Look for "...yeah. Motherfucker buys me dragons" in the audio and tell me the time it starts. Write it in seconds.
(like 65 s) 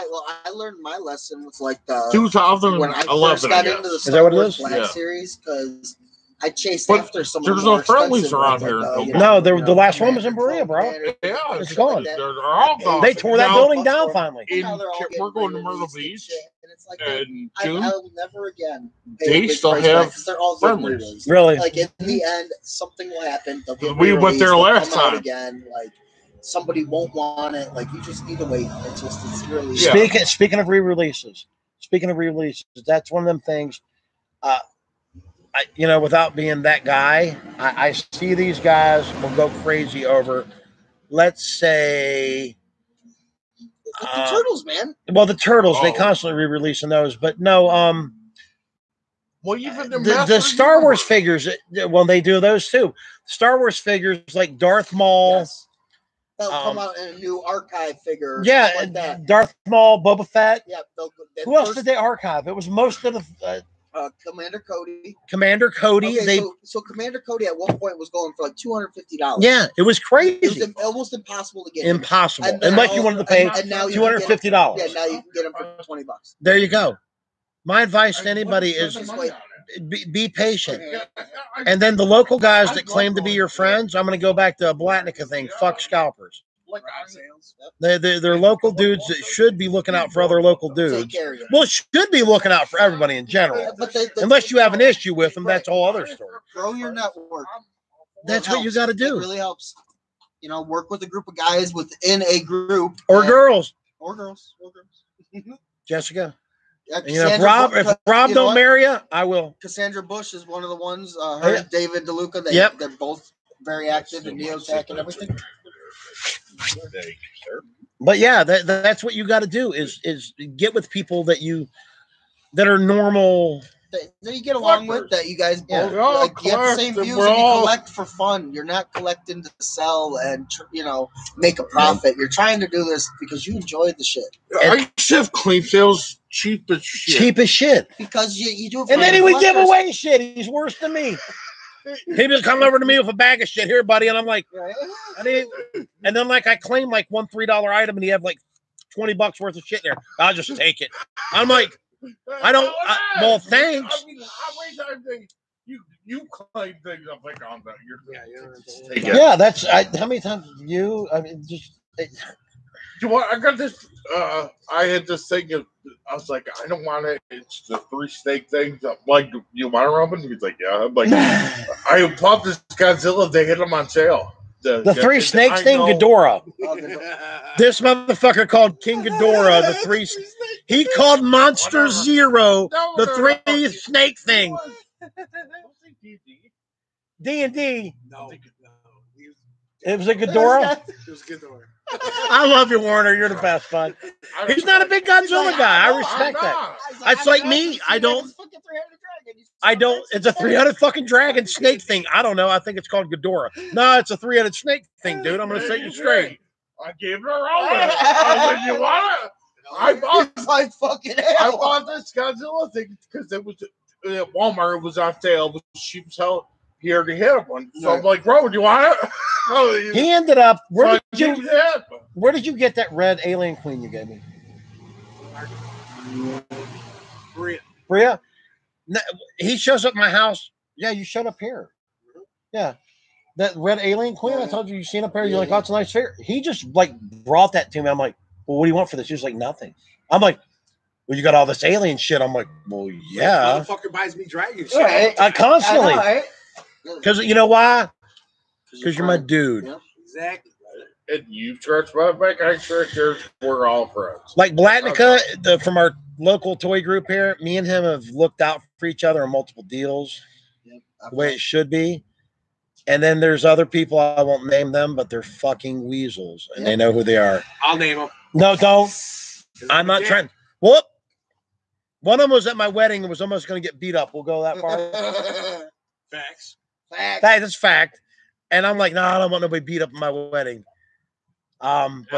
243 s.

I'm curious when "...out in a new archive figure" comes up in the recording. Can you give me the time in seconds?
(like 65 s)
56 s.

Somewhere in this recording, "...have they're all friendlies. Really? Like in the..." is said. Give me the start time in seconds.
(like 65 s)
19 s.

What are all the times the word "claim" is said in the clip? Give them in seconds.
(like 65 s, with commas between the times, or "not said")
82 s, 146 s, 156 s.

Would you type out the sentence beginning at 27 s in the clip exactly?
Like you just need to wait until it's really.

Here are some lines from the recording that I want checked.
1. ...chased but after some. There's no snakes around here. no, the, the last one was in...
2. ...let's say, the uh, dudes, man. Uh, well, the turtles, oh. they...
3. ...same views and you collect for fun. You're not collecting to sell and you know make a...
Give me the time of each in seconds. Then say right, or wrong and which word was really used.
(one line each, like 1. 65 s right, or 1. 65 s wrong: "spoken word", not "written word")
1. 6 s wrong: "friendlies", not "snakes"
2. 41 s wrong: "turtles", not "dudes"
3. 126 s right.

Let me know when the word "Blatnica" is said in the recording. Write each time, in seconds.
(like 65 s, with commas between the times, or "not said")
84 s, 254 s.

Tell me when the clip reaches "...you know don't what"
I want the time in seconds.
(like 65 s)
108 s.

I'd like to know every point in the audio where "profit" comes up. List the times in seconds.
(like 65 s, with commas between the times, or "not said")
131 s.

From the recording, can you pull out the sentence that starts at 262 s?
And then there's other people, I won't name them, but they're fucking weasels and yep.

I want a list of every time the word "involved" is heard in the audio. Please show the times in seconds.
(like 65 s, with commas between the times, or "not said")
not said.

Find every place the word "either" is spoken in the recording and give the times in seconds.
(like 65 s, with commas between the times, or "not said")
not said.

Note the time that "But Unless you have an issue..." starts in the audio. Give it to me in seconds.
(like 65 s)
93 s.